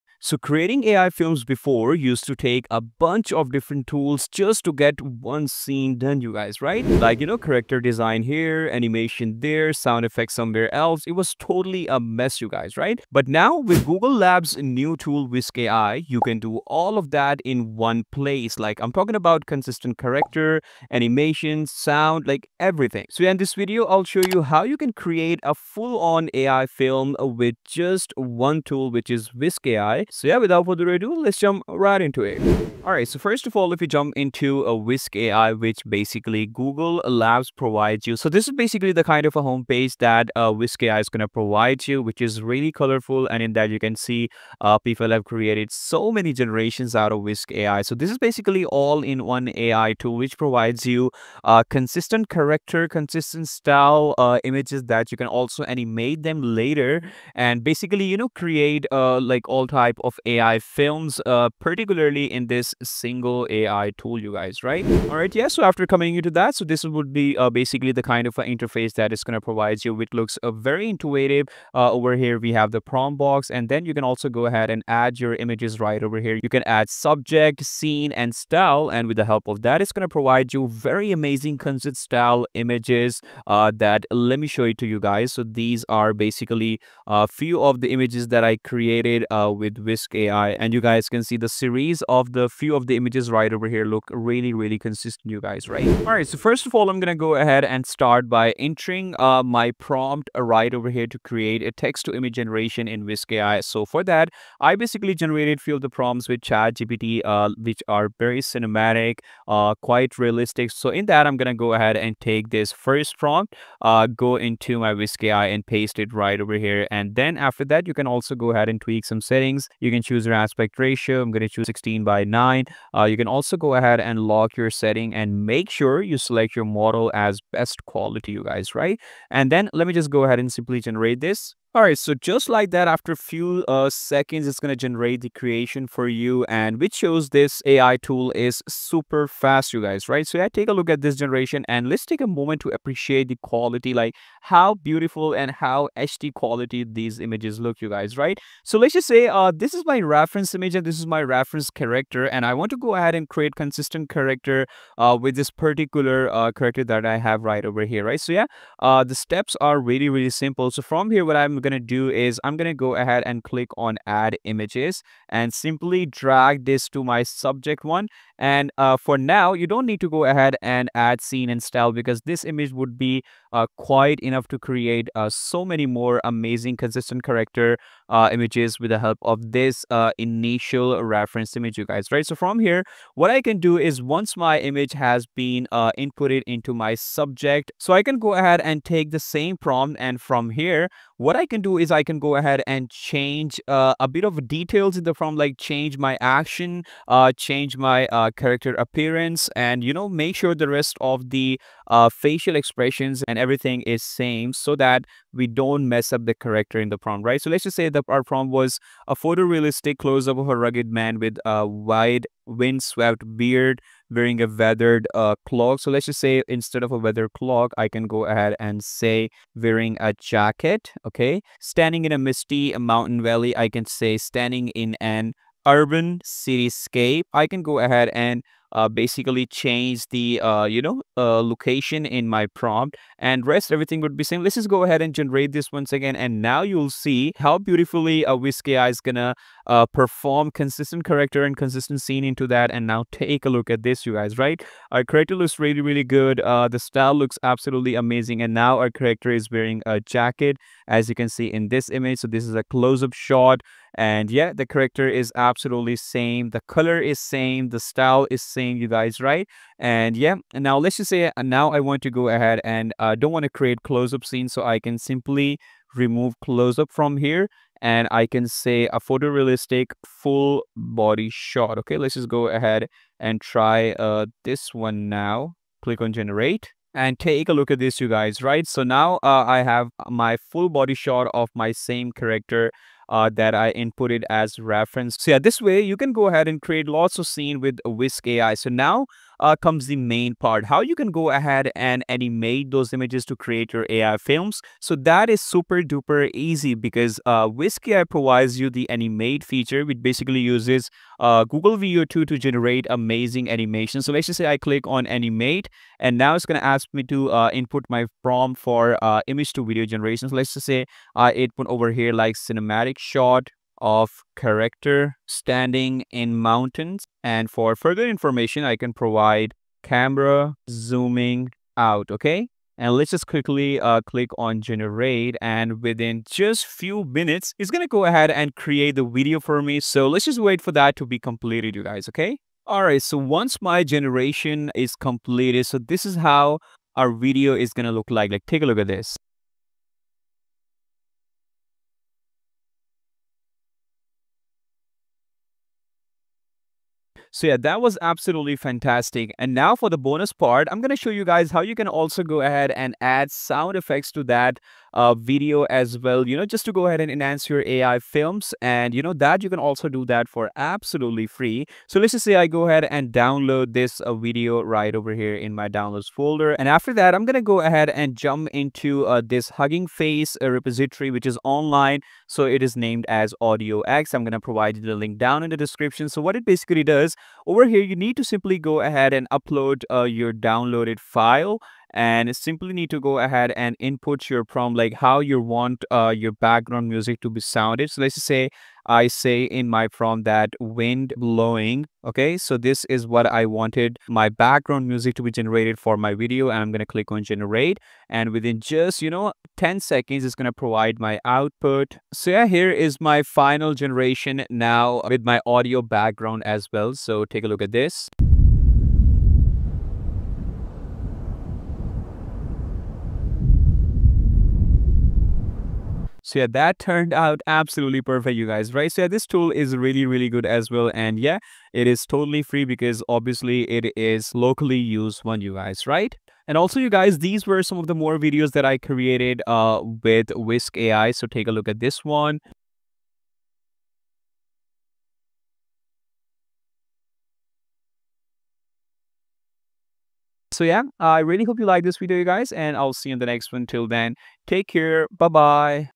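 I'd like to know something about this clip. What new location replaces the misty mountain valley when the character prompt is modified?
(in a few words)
urban cityscape.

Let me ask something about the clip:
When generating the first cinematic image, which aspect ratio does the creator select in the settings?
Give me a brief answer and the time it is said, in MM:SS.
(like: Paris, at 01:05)
16 by 9, at 02:01.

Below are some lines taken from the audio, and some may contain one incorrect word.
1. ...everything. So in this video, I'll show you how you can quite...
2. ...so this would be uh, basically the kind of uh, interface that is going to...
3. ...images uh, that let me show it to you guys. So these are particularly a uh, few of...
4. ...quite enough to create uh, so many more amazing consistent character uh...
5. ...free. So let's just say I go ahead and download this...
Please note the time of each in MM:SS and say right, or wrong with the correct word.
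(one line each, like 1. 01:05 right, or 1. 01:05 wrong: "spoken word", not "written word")
1. 00:22 wrong: "create", not "quite"
2. 01:06 right
3. 01:22 wrong: "basically", not "particularly"
4. 02:53 right
5. 06:01 right.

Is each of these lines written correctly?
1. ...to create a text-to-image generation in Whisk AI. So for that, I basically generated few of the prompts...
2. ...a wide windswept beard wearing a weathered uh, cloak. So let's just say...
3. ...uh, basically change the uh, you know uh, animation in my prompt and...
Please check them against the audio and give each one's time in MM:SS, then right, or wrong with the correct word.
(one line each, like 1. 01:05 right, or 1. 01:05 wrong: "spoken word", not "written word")
1. 01:41 right
2. 03:31 right
3. 03:48 wrong: "location", not "animation".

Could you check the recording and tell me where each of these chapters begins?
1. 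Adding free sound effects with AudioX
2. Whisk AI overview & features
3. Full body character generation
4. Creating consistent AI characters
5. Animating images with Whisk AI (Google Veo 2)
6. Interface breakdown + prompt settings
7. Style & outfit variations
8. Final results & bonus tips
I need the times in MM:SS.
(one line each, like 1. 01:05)
1. 06:20
2. 00:28
3. 04:10
4. 01:55
5. 05:15
6. 01:05
7. 03:05
8. 07:10.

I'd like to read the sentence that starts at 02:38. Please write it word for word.
So yeah, uh, the steps are really, really simple.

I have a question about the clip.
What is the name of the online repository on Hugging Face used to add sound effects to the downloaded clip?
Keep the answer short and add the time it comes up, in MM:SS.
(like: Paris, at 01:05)
AudioX, at 06:13.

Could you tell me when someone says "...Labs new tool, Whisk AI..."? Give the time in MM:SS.
00:14.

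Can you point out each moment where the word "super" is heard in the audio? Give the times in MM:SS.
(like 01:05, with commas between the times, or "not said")
02:18, 04:55.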